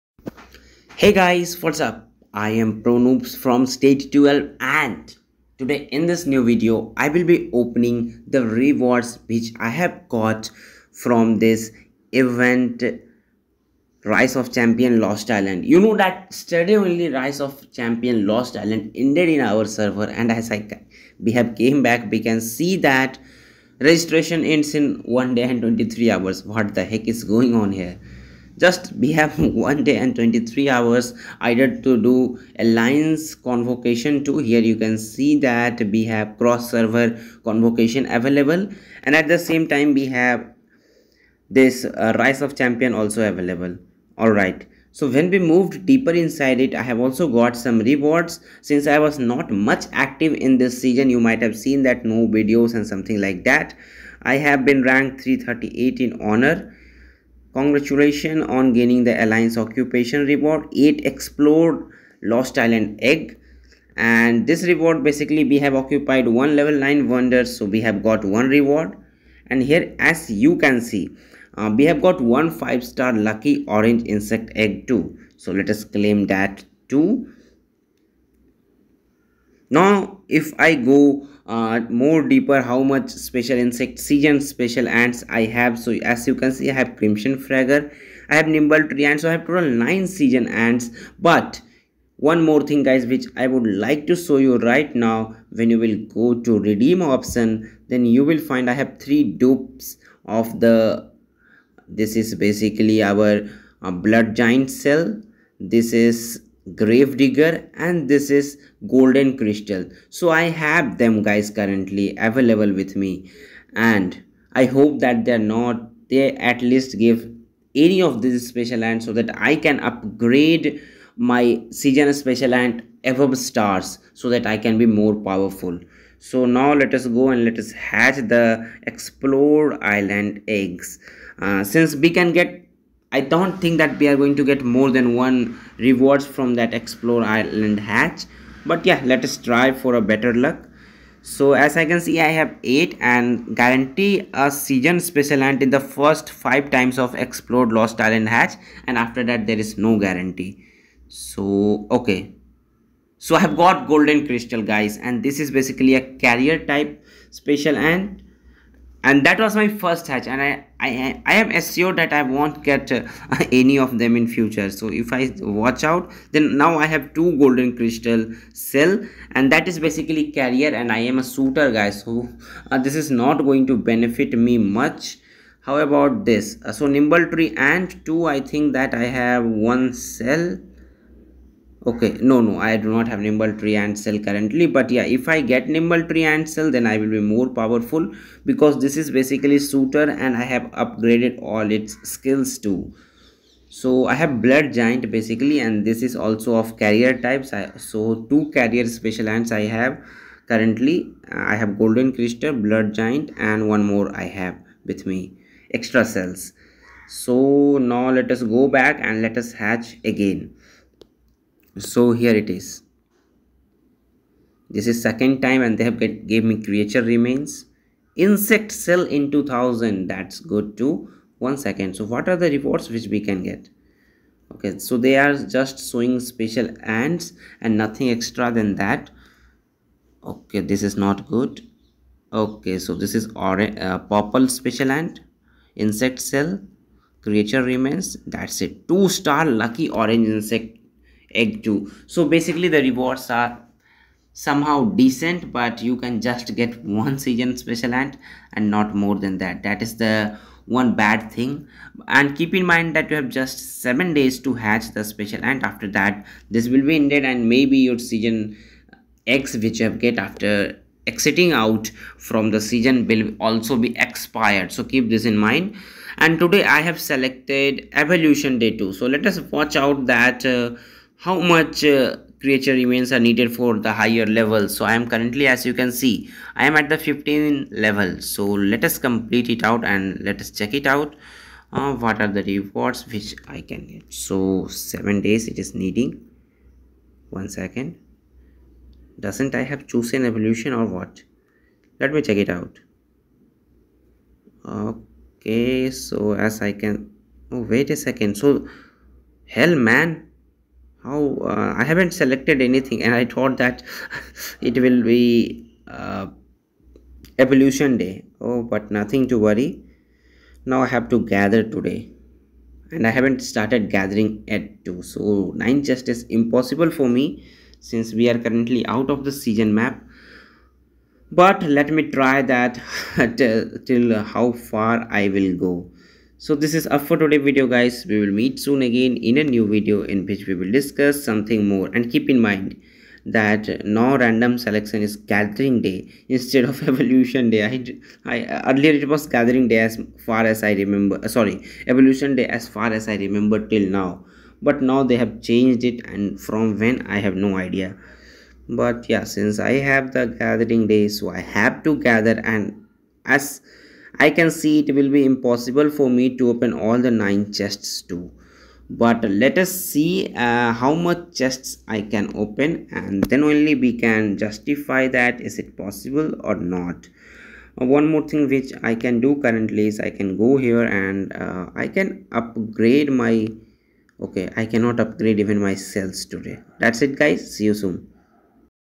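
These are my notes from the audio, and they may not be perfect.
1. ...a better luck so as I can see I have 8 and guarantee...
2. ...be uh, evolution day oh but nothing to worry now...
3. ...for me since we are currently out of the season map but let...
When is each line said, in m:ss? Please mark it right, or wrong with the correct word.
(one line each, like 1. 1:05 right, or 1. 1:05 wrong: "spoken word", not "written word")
1. 2:19 right
2. 5:05 right
3. 5:16 right.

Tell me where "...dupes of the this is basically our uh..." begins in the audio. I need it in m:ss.
1:39.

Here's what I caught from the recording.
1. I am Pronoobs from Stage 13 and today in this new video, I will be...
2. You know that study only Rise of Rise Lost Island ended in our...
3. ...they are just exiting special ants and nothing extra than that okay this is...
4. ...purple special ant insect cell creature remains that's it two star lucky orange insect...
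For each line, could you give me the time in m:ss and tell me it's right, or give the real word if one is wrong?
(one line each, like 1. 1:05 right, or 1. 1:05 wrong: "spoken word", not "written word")
1. 0:02 wrong: "12", not "13"
2. 0:15 wrong: "Champion", not "Rise"
3. 3:44 wrong: "showing", not "exiting"
4. 3:53 right.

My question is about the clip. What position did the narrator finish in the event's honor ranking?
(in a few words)
338.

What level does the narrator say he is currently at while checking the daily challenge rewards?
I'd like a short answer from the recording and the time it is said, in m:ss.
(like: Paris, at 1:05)
15, at 4:36.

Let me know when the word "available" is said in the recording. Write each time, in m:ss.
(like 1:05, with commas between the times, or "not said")
0:38, 0:43, 1:52.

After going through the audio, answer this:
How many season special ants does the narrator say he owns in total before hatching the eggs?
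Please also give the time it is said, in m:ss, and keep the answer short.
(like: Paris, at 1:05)
9, at 1:29.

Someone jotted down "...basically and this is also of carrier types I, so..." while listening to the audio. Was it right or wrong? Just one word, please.
right.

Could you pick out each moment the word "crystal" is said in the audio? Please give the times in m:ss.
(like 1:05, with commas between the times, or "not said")
1:49, 2:34, 2:47, 3:22.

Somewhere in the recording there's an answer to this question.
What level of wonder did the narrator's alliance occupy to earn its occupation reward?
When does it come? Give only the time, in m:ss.
1:06.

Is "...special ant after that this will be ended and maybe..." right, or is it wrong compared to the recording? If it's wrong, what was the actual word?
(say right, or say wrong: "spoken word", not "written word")
right.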